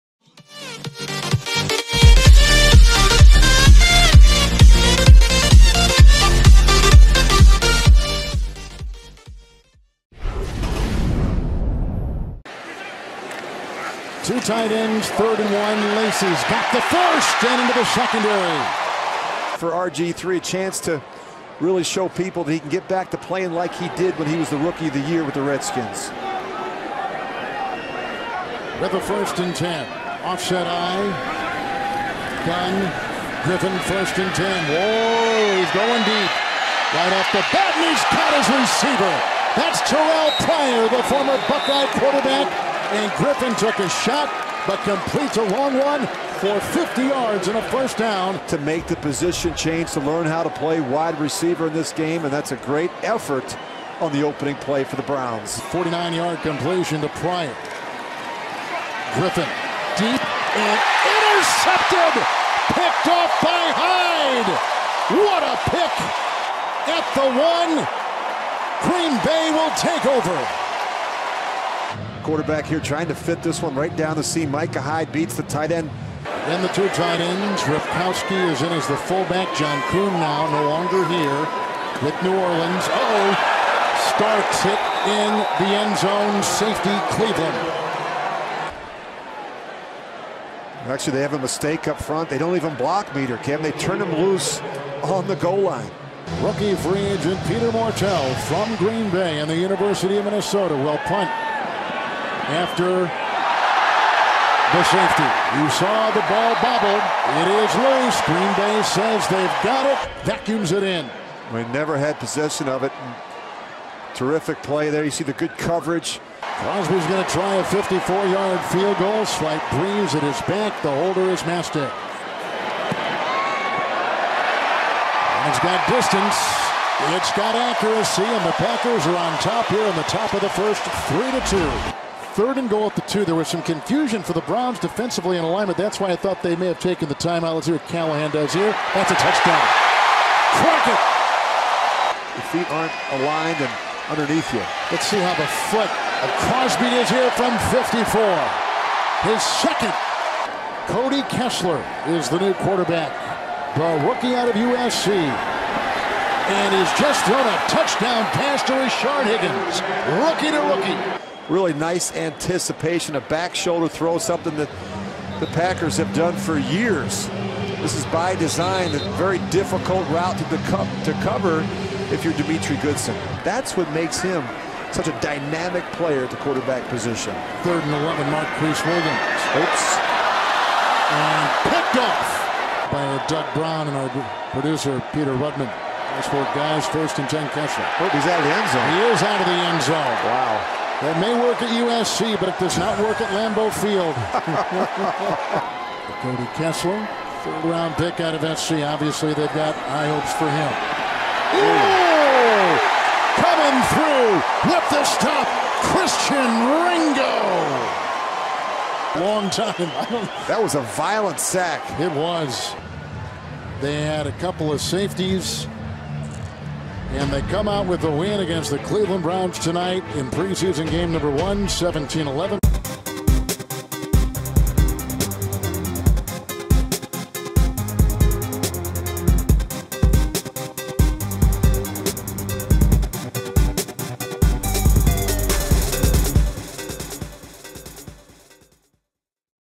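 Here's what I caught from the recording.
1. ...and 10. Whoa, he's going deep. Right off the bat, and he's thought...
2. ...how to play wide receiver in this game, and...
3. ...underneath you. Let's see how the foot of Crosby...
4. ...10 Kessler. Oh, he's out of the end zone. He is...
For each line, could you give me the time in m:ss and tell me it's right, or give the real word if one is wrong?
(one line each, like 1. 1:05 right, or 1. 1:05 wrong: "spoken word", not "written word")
1. 0:34 wrong: "caught", not "thought"
2. 0:50 right
3. 2:24 right
4. 3:07 right.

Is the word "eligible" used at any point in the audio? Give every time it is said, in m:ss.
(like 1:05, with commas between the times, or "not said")
not said.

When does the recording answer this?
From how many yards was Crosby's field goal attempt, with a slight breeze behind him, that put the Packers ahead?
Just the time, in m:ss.
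1:57.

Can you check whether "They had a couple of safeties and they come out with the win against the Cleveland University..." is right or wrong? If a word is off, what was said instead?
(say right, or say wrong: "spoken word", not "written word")
wrong: "Browns", not "University".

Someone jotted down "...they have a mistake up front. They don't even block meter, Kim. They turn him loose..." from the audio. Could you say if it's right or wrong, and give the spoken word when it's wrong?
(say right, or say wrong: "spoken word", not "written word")
right.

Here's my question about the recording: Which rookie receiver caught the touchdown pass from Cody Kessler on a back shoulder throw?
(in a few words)
Rashard Higgins.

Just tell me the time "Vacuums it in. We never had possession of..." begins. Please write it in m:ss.
1:50.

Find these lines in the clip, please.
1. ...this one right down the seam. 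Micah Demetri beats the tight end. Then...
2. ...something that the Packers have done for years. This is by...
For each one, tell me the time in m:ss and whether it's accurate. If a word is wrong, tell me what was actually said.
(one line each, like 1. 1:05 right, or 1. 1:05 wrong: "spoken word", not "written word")
1. 1:13 wrong: "Hyde", not "Demetri"
2. 2:44 right.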